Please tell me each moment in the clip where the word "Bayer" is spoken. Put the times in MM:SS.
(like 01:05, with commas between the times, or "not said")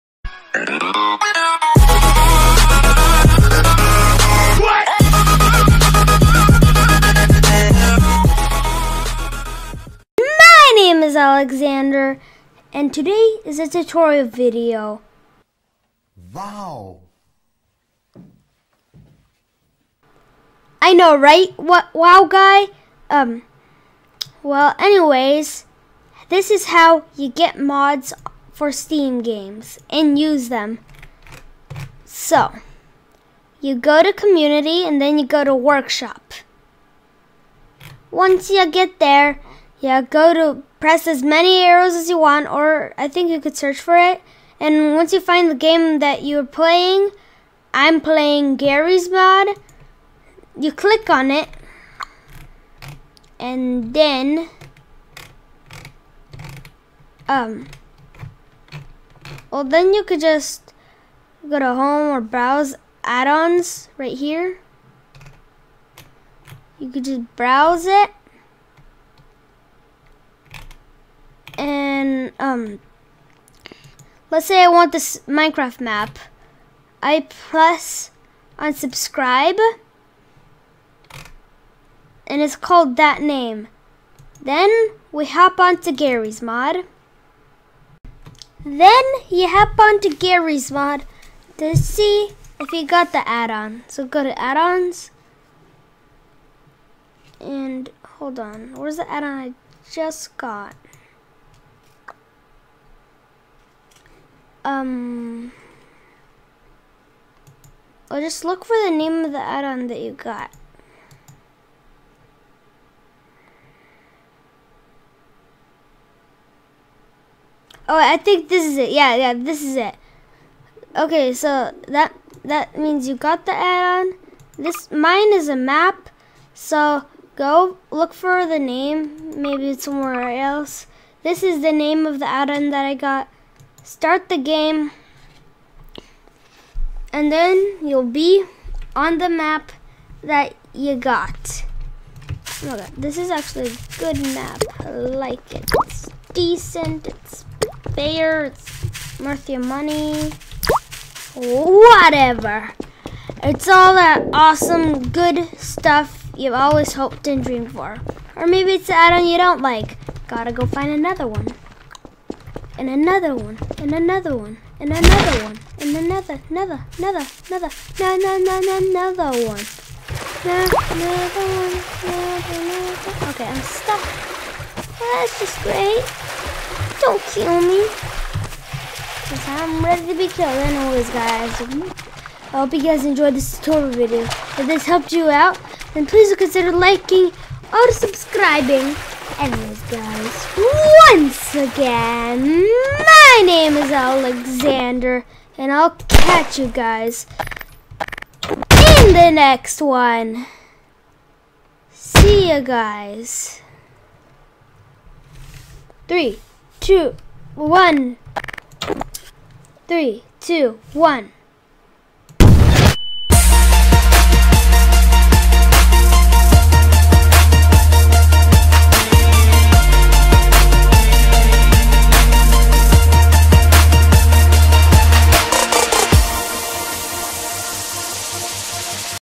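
02:27.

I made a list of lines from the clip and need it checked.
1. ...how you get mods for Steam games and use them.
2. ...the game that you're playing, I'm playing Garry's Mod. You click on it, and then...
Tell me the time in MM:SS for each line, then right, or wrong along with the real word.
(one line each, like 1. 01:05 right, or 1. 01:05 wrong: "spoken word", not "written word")
1. 00:26 right
2. 00:45 right.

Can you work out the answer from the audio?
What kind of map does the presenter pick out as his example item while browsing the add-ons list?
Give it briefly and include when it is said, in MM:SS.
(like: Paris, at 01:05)
Minecraft map, at 01:15.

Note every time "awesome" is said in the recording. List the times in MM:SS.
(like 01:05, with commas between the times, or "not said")
02:34.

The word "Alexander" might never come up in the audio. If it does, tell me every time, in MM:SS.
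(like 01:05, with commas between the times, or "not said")
00:11, 03:13.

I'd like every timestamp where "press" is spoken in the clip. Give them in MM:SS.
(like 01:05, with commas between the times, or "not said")
00:40, 01:17.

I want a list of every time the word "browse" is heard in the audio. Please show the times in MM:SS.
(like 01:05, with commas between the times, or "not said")
01:02, 01:07.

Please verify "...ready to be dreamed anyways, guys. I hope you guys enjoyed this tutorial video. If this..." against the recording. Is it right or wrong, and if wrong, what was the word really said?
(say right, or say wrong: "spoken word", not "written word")
wrong: "killed", not "dreamed".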